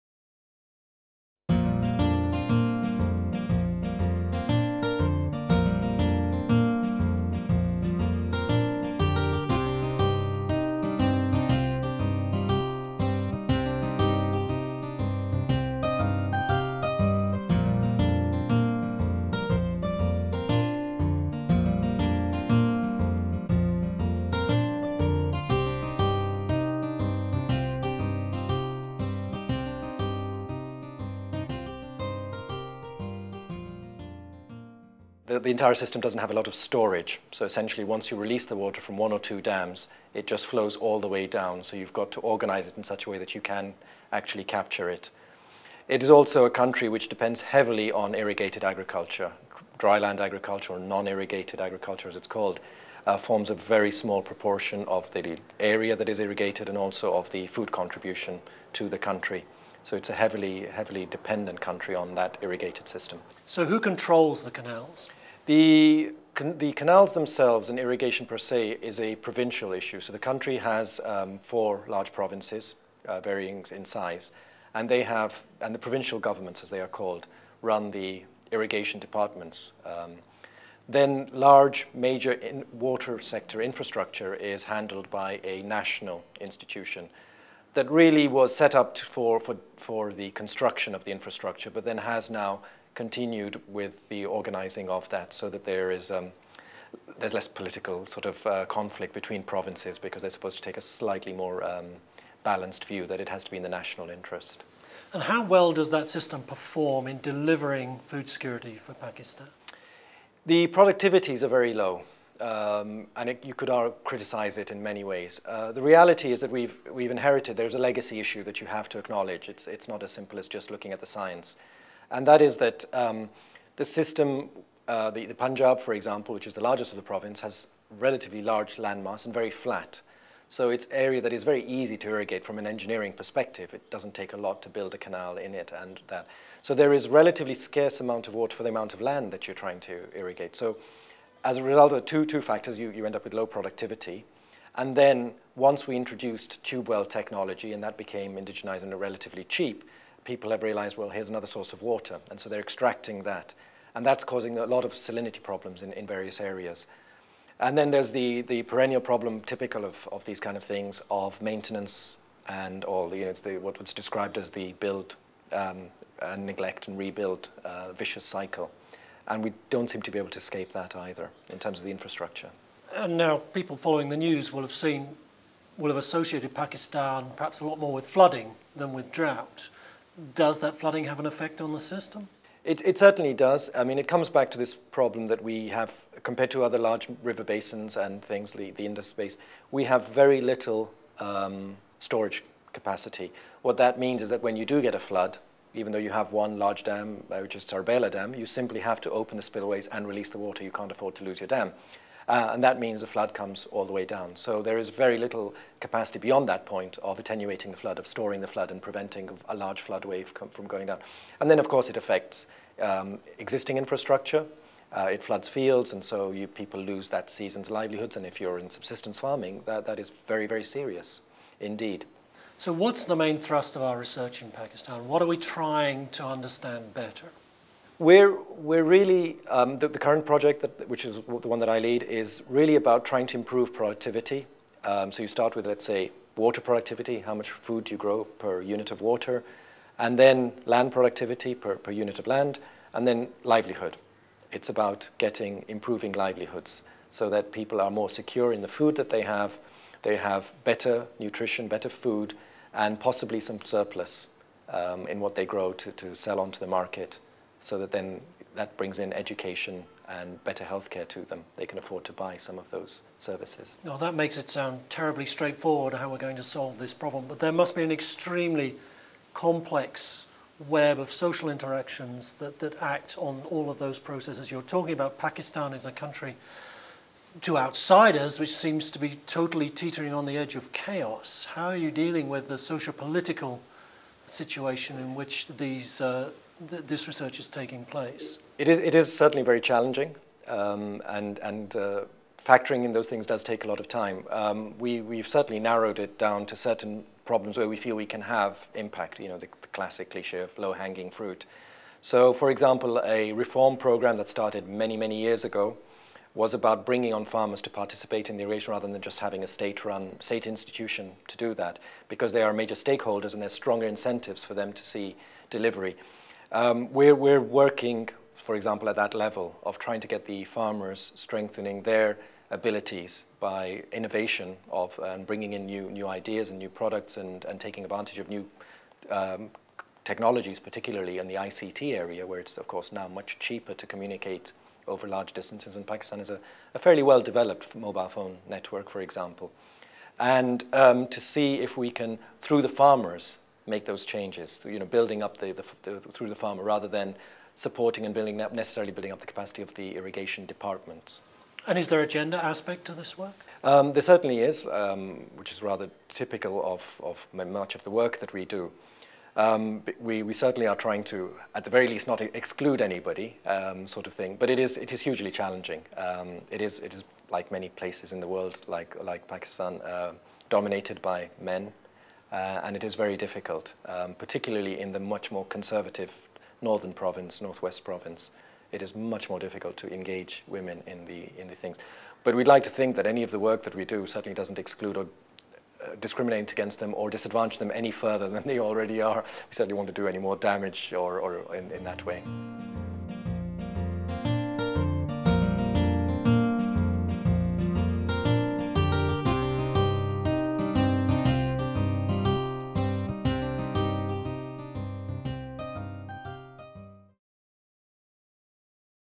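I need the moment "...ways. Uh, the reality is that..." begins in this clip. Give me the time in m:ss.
1:55.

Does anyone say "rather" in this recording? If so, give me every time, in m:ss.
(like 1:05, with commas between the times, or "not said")
5:08, 5:46, 5:55.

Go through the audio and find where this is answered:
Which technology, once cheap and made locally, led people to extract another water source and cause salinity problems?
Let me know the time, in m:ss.
2:26.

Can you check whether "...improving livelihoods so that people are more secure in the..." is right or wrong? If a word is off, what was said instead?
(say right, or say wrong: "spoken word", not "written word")
right.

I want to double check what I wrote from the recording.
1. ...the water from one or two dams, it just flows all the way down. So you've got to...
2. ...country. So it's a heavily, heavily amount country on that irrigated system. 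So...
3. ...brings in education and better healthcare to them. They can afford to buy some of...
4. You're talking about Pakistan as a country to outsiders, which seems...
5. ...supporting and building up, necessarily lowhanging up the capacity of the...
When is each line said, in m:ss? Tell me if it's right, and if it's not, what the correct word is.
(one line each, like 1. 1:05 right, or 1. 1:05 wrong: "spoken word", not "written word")
1. 0:38 right
2. 0:58 wrong: "dependent", not "amount"
3. 4:18 right
4. 4:34 right
5. 5:47 wrong: "building", not "lowhanging".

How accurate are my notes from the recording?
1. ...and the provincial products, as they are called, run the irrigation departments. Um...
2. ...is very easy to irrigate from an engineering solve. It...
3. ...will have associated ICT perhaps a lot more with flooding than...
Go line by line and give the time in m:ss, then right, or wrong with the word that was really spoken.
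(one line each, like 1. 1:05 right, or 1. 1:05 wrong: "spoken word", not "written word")
1. 1:15 wrong: "governments", not "products"
2. 2:11 wrong: "perspective", not "solve"
3. 2:55 wrong: "Pakistan", not "ICT".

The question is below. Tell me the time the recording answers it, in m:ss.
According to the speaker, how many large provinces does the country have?
1:11.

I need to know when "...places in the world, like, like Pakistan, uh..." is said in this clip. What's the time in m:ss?
6:07.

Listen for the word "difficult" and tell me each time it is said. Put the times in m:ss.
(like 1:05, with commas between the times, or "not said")
6:13, 6:19.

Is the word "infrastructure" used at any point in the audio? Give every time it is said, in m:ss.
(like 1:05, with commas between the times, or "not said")
1:23, 1:31, 2:51, 3:33.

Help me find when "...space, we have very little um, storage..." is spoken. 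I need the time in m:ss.
3:09.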